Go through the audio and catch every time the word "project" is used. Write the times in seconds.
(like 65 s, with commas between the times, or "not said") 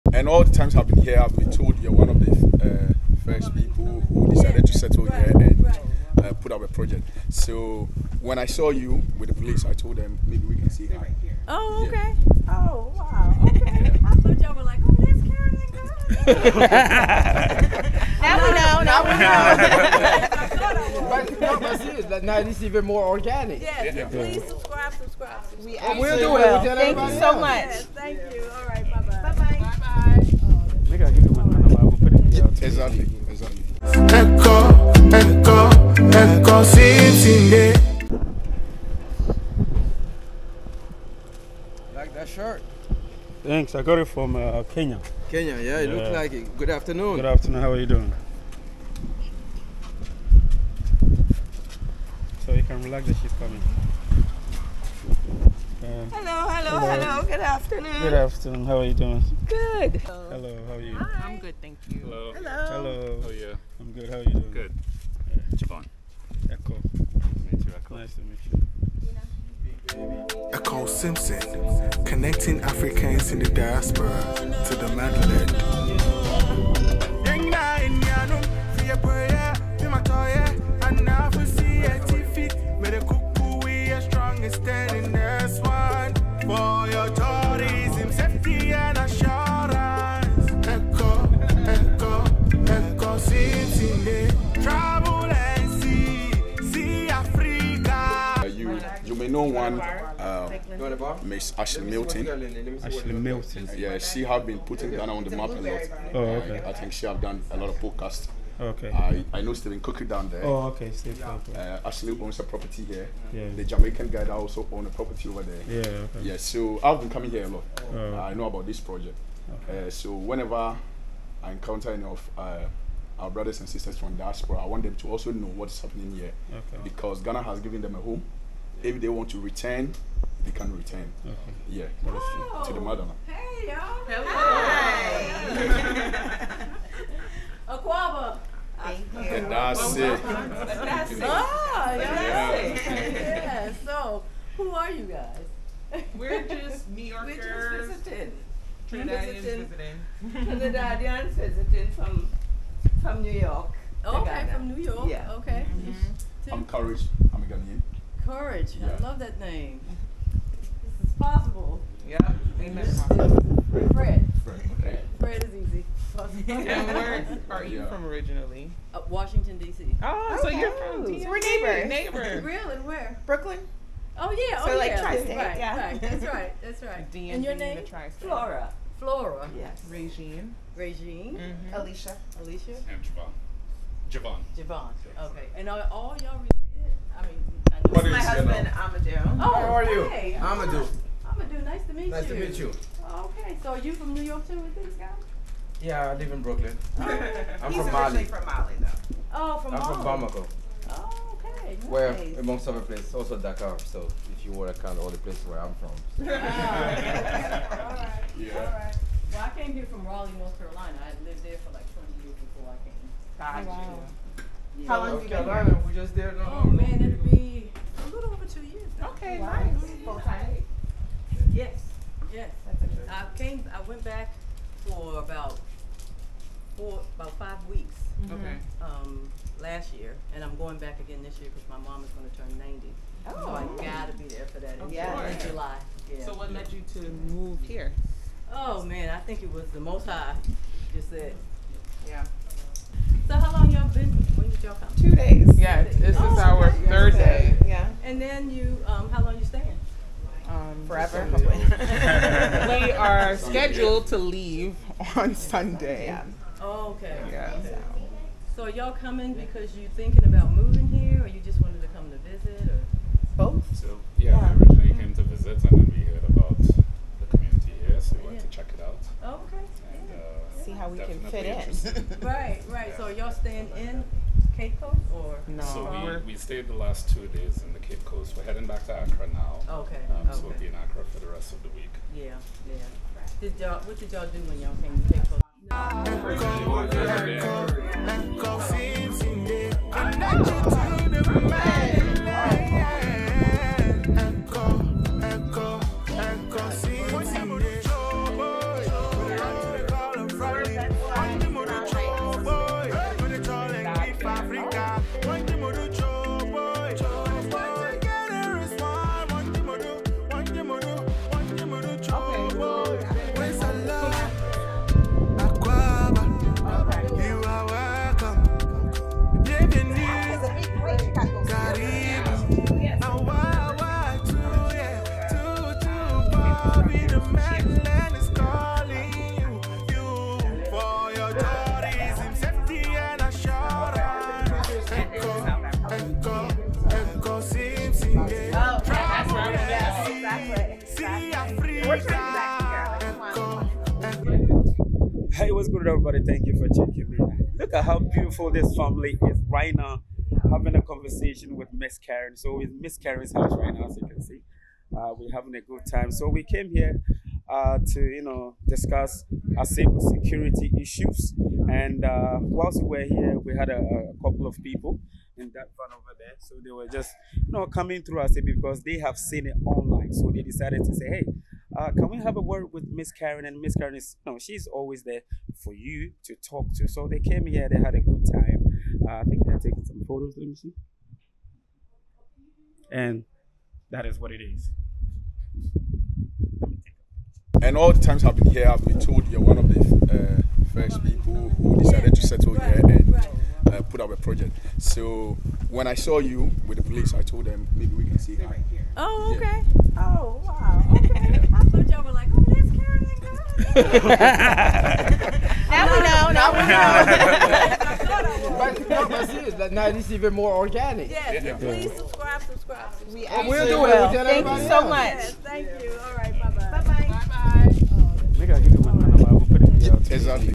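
6 s, 118 s, 394 s.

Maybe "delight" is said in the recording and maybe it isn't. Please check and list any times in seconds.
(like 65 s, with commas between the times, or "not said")
not said.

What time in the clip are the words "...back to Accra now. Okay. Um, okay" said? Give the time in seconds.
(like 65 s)
278 s.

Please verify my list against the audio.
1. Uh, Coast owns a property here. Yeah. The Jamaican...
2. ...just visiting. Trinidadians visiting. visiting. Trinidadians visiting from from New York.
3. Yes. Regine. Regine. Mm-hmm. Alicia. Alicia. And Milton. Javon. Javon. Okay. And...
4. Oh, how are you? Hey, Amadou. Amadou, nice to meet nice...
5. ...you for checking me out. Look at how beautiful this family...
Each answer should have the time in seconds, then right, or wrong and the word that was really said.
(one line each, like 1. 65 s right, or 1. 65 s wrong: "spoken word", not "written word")
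1. 111 s wrong: "Ashley", not "Coast"
2. 147 s right
3. 179 s wrong: "Javon", not "Milton"
4. 189 s right
5. 346 s right.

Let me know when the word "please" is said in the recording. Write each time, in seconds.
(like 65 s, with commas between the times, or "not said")
24 s, 411 s.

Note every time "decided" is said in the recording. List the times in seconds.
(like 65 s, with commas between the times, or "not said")
4 s, 370 s, 391 s.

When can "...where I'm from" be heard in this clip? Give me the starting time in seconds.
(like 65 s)
205 s.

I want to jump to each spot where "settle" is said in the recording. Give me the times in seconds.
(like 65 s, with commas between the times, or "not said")
4 s, 392 s.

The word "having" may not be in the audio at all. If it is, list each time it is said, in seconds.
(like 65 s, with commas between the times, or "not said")
350 s, 355 s.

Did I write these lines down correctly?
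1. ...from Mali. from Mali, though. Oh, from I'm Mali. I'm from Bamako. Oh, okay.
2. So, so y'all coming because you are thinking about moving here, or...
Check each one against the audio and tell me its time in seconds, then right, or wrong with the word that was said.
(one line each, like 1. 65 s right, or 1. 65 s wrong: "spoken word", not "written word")
1. 197 s right
2. 257 s right.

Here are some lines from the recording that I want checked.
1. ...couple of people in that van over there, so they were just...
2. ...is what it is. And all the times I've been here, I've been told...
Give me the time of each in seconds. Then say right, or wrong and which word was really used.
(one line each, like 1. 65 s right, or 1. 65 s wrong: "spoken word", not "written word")
1. 364 s right
2. 384 s right.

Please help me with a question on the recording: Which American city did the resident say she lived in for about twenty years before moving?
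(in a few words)
Raleigh, North Carolina.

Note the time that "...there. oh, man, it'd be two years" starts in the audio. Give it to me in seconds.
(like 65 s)
216 s.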